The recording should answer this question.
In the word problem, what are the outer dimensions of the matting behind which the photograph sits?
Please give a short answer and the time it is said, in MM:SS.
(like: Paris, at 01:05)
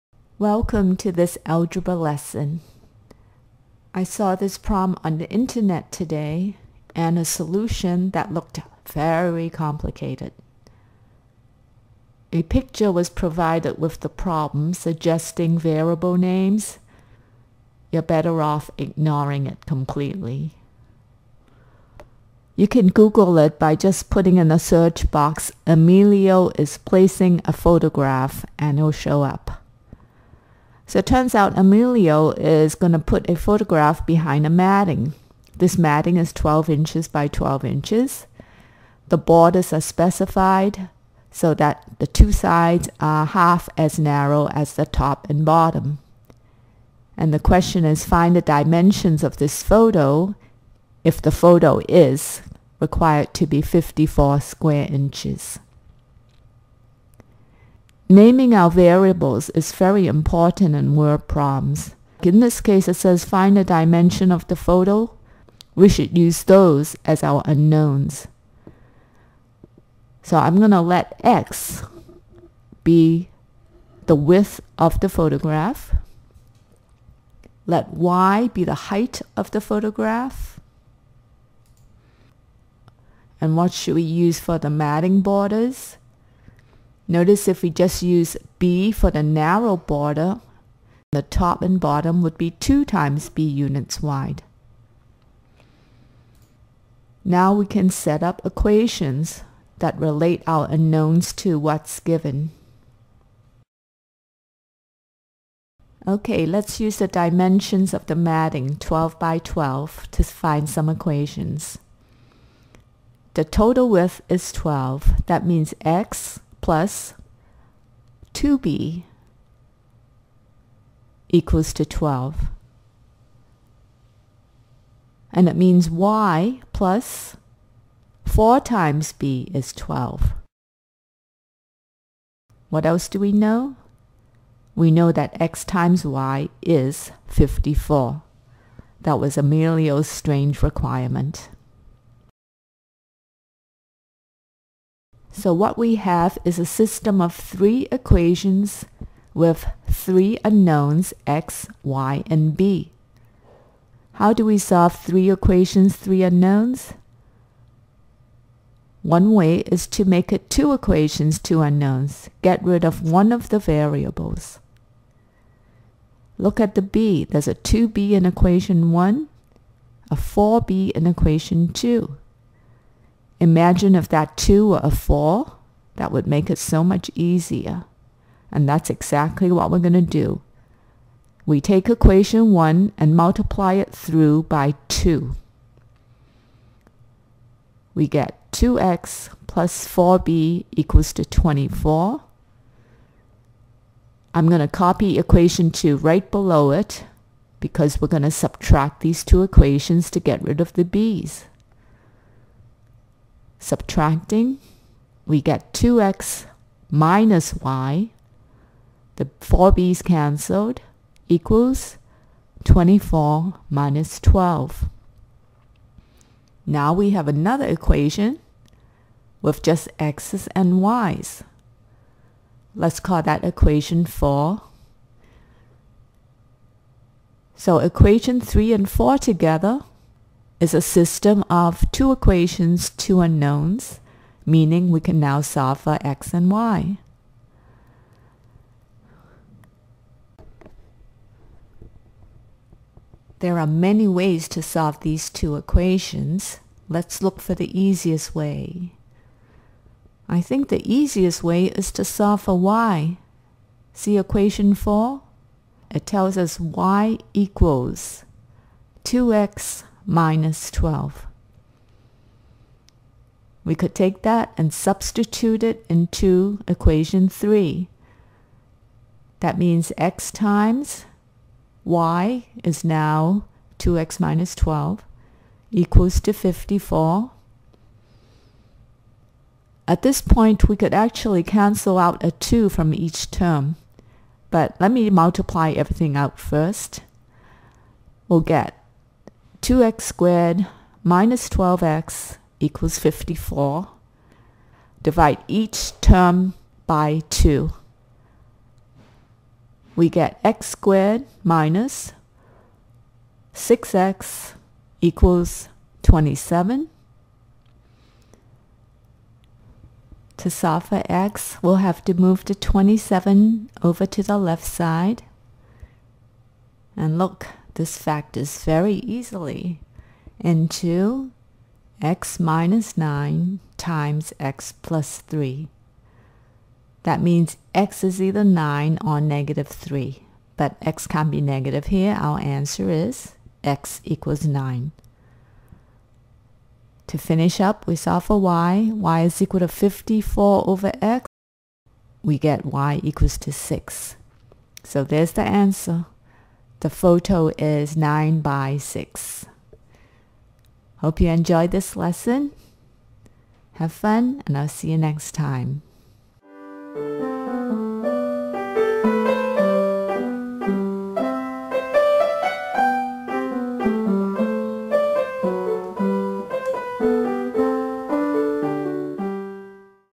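12 by 12 inches, at 00:36.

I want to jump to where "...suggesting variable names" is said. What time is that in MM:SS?
00:14.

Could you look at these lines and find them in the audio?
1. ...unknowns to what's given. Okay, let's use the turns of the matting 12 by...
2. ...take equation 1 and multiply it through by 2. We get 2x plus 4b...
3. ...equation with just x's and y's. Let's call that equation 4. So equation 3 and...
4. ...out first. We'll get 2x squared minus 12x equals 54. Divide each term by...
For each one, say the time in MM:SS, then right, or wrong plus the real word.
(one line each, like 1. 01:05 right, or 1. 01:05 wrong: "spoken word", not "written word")
1. 01:40 wrong: "dimensions", not "turns"
2. 03:01 right
3. 03:37 right
4. 04:46 right.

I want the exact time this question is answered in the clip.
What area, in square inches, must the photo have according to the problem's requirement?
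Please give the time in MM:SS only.
00:53.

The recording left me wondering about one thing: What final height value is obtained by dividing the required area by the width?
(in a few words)
6.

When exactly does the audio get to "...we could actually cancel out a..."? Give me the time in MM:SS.
04:40.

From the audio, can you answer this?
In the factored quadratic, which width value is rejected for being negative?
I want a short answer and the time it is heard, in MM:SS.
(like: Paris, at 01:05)
-3, at 05:29.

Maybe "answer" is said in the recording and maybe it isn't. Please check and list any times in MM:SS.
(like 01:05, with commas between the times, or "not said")
05:32, 05:45.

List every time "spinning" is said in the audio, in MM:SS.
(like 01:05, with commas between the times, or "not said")
not said.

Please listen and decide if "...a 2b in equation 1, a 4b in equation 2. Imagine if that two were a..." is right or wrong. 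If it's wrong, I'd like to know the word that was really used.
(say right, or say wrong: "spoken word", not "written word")
right.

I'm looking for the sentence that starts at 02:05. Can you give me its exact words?
And it means y plus 4 times b is 12.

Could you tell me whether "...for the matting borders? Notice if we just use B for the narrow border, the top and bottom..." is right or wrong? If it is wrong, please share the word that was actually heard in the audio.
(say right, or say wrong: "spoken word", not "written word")
right.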